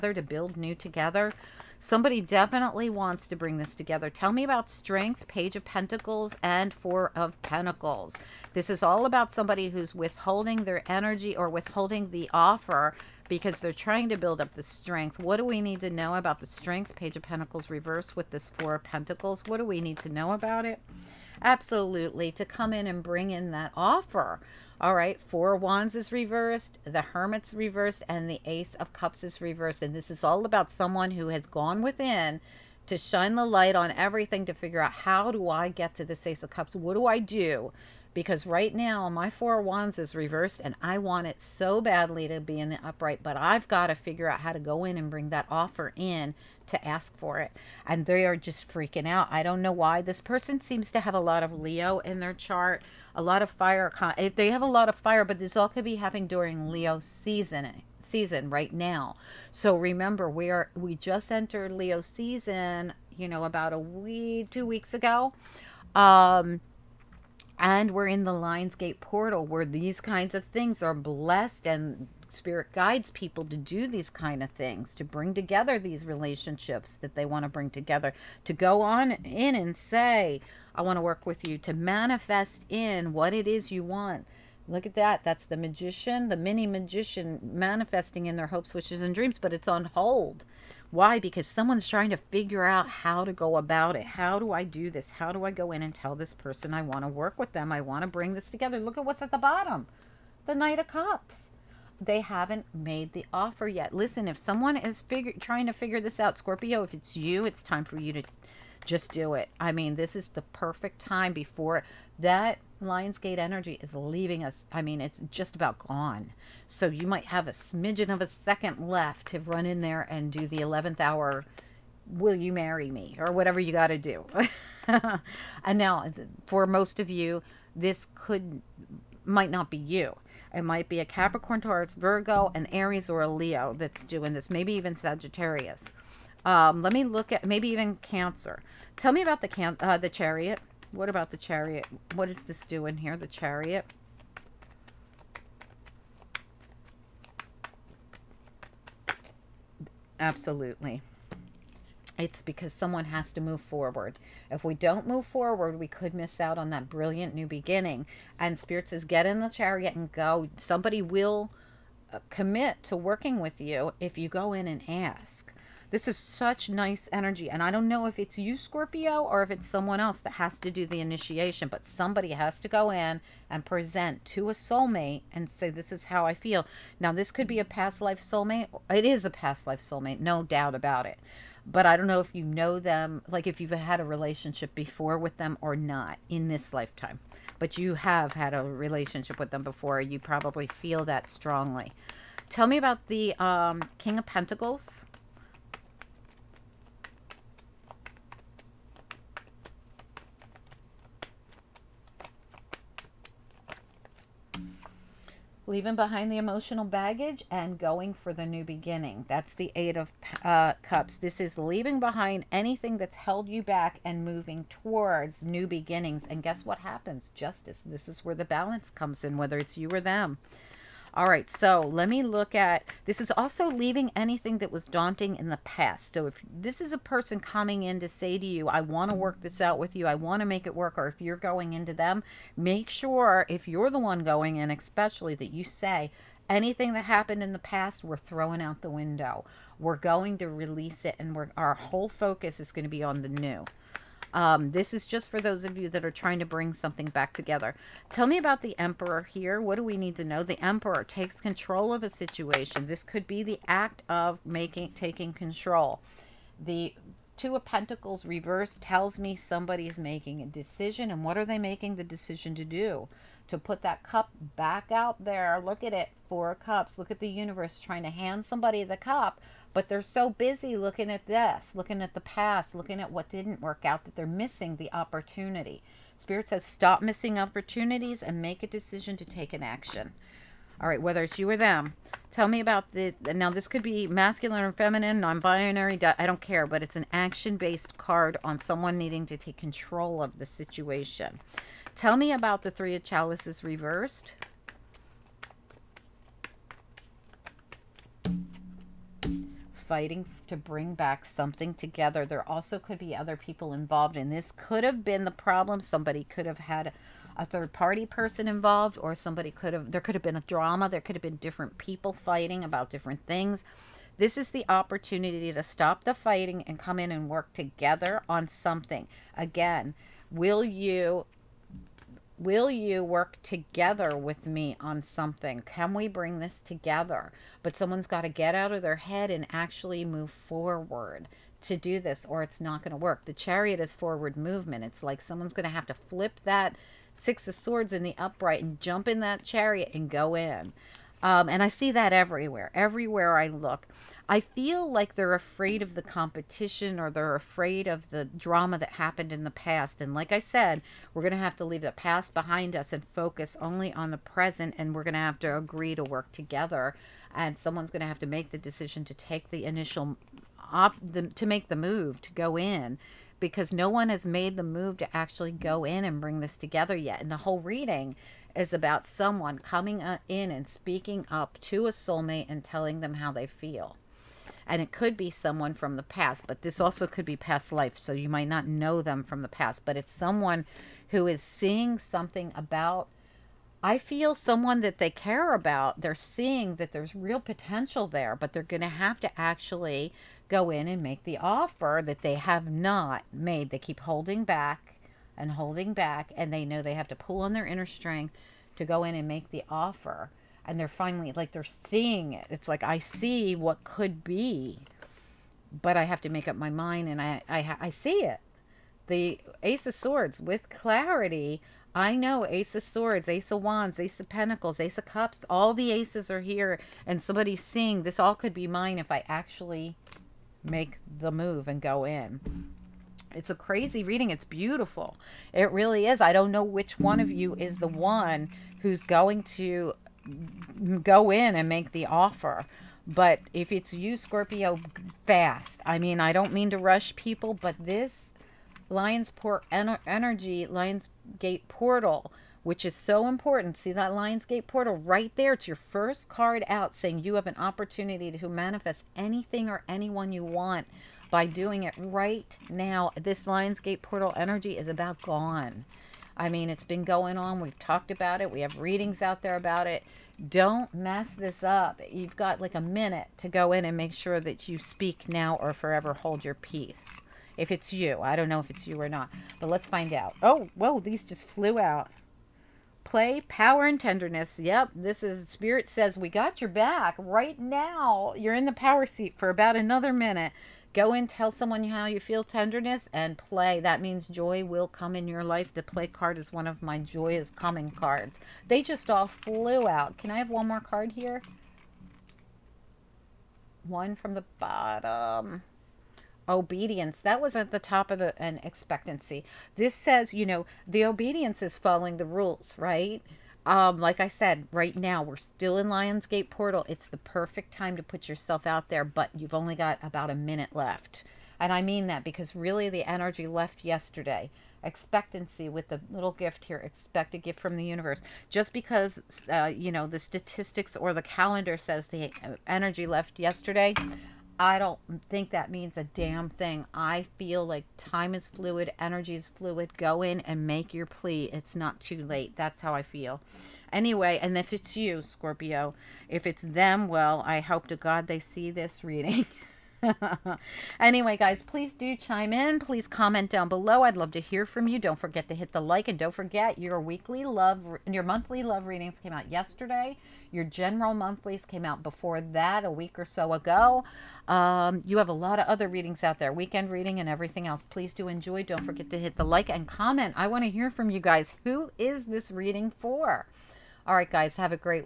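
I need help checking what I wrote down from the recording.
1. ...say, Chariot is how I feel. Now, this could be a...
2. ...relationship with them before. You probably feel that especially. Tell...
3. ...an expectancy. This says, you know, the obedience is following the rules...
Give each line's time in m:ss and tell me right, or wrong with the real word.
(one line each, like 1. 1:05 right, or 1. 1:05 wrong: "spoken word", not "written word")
1. 2:55 wrong: "This", not "Chariot"
2. 3:08 wrong: "strongly", not "especially"
3. 8:18 right.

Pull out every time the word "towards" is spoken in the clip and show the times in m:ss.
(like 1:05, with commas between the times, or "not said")
3:34.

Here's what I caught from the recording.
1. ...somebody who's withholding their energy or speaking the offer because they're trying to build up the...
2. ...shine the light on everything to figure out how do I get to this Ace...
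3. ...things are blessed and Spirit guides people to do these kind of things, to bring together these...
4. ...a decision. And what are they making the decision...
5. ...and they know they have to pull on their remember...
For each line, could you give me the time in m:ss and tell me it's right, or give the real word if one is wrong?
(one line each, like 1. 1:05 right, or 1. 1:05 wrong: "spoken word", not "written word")
1. 0:09 wrong: "withholding", not "speaking"
2. 0:32 right
3. 1:10 right
4. 4:20 right
5. 6:36 wrong: "inner", not "remember".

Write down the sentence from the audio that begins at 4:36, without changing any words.
Spirit says, stop missing opportunities and make a decision to take an action.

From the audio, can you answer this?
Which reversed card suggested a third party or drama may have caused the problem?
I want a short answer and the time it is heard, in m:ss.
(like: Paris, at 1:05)
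Three of Chalices, at 4:52.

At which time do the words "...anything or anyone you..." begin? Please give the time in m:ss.
7:29.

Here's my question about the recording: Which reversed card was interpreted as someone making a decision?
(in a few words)
Two of Pentacles.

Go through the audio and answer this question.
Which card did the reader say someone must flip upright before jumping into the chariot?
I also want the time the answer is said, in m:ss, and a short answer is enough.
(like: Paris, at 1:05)
Six of Swords, at 5:37.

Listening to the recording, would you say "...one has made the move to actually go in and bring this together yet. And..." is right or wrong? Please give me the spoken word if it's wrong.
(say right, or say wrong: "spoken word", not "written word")
right.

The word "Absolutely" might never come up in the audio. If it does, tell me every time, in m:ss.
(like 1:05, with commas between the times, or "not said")
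0:21, 2:30.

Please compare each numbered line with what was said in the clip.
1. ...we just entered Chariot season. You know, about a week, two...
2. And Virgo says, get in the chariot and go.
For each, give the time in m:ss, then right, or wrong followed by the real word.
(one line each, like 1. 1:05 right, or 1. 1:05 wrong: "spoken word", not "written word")
1. 1:00 wrong: "Leo", not "Chariot"
2. 2:38 wrong: "Spirit", not "Virgo".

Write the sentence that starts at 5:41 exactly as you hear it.
Um, and I see that everywhere, everywhere I look.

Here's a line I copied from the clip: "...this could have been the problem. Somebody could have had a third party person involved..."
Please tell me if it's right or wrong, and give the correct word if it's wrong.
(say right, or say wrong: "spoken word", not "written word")
right.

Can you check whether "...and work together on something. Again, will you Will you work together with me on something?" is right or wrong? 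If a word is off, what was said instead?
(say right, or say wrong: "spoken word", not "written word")
right.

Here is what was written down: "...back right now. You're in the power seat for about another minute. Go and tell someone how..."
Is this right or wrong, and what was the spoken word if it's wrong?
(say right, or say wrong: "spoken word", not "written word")
right.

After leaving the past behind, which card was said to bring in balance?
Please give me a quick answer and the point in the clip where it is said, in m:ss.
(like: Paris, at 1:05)
Justice, at 3:37.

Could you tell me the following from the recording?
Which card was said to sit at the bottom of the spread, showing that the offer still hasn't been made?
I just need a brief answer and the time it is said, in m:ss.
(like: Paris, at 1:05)
Knight of Cups, at 1:40.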